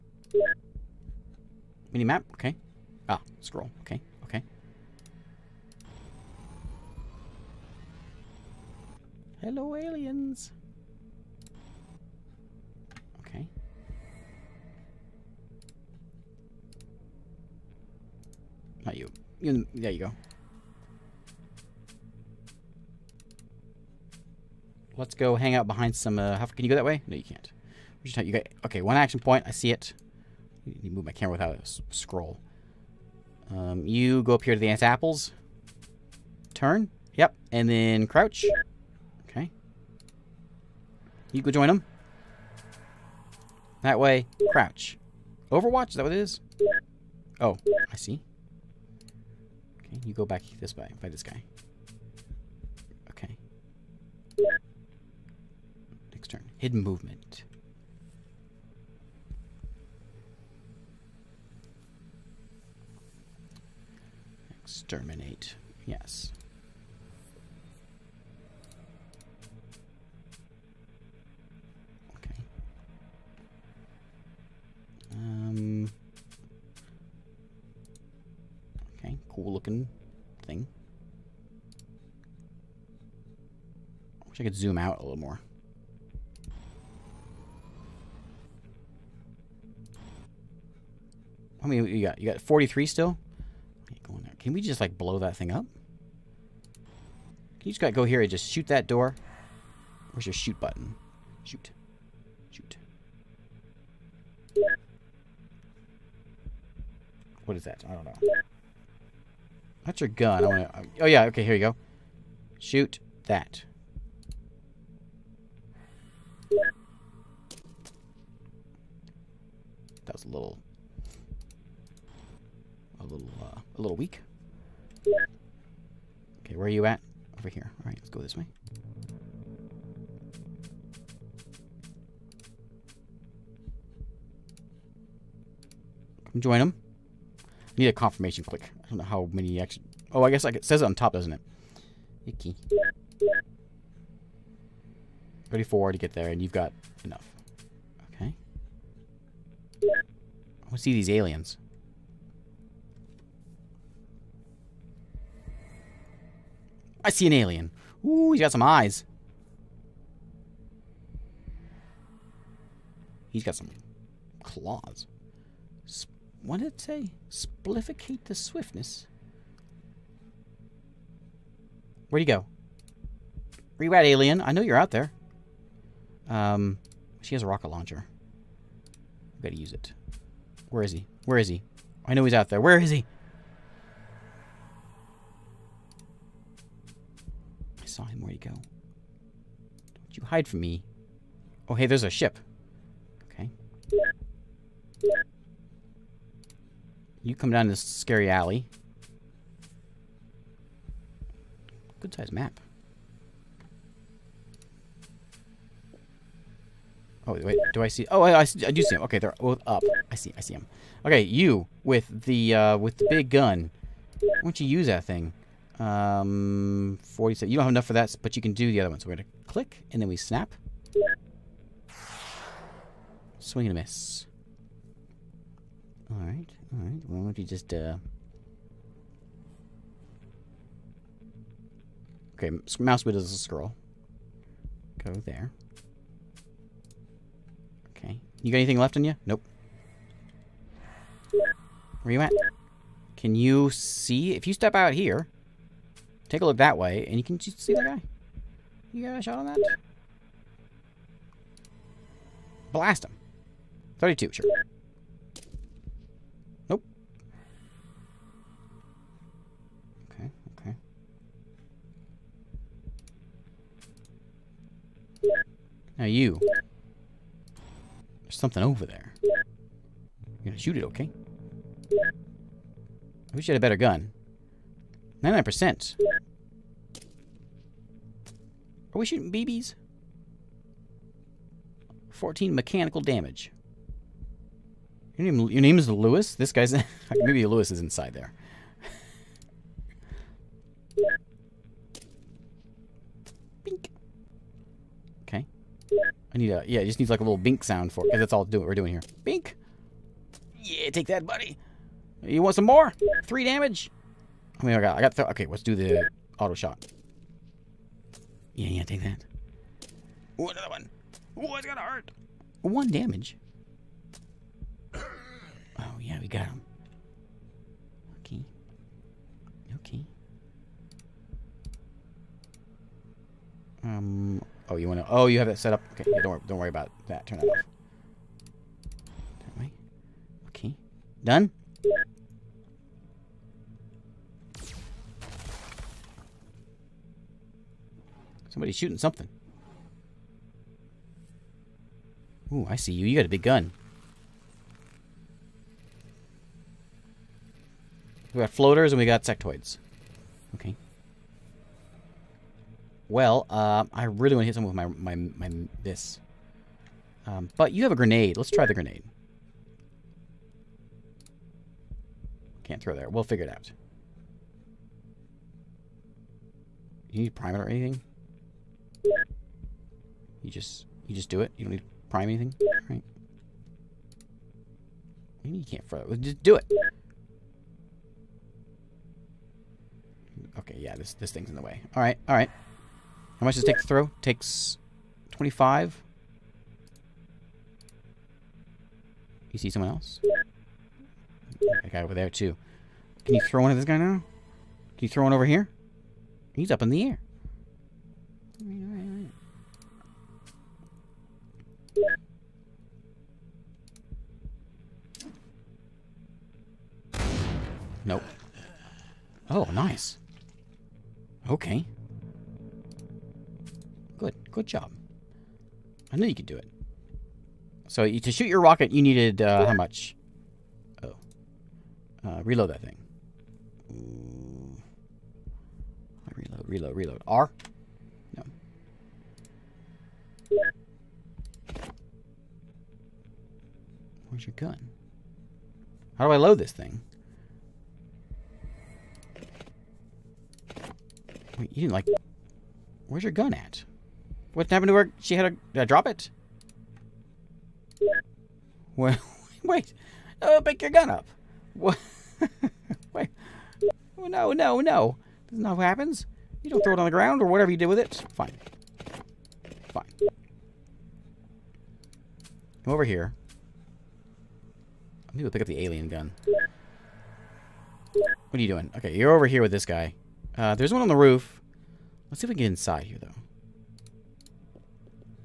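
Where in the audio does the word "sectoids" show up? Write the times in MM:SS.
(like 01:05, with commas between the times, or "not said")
05:49.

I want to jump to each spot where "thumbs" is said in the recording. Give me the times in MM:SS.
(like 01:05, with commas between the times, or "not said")
not said.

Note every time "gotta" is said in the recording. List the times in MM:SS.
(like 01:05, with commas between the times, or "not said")
01:37, 02:59.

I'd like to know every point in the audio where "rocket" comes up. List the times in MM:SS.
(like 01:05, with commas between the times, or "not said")
02:57, 06:58.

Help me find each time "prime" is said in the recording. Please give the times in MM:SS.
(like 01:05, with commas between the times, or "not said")
06:07, 06:12.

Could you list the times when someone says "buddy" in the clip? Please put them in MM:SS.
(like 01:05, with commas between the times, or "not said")
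05:01.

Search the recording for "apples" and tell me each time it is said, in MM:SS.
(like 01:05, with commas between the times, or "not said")
00:34.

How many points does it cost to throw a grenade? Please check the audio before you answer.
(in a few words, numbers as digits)
25.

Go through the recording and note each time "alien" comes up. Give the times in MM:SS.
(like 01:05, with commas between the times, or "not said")
00:09, 02:31, 02:37, 02:54, 07:45.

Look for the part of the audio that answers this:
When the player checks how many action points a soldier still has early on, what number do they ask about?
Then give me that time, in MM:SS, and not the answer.
01:32.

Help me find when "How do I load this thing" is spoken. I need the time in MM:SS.
07:16.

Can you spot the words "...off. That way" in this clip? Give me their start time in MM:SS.
05:27.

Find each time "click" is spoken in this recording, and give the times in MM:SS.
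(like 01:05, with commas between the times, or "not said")
02:18, 03:39.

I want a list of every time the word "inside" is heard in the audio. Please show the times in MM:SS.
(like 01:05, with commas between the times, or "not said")
04:47, 07:52.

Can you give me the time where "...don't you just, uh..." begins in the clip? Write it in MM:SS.
03:47.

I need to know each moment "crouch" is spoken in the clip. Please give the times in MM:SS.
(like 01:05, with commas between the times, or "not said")
00:38, 00:44.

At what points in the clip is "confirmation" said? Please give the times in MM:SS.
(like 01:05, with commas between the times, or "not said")
02:17.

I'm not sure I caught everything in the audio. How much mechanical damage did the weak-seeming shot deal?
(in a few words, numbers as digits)
14.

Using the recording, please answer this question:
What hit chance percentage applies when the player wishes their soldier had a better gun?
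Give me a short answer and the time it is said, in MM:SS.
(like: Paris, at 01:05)
99%, at 04:35.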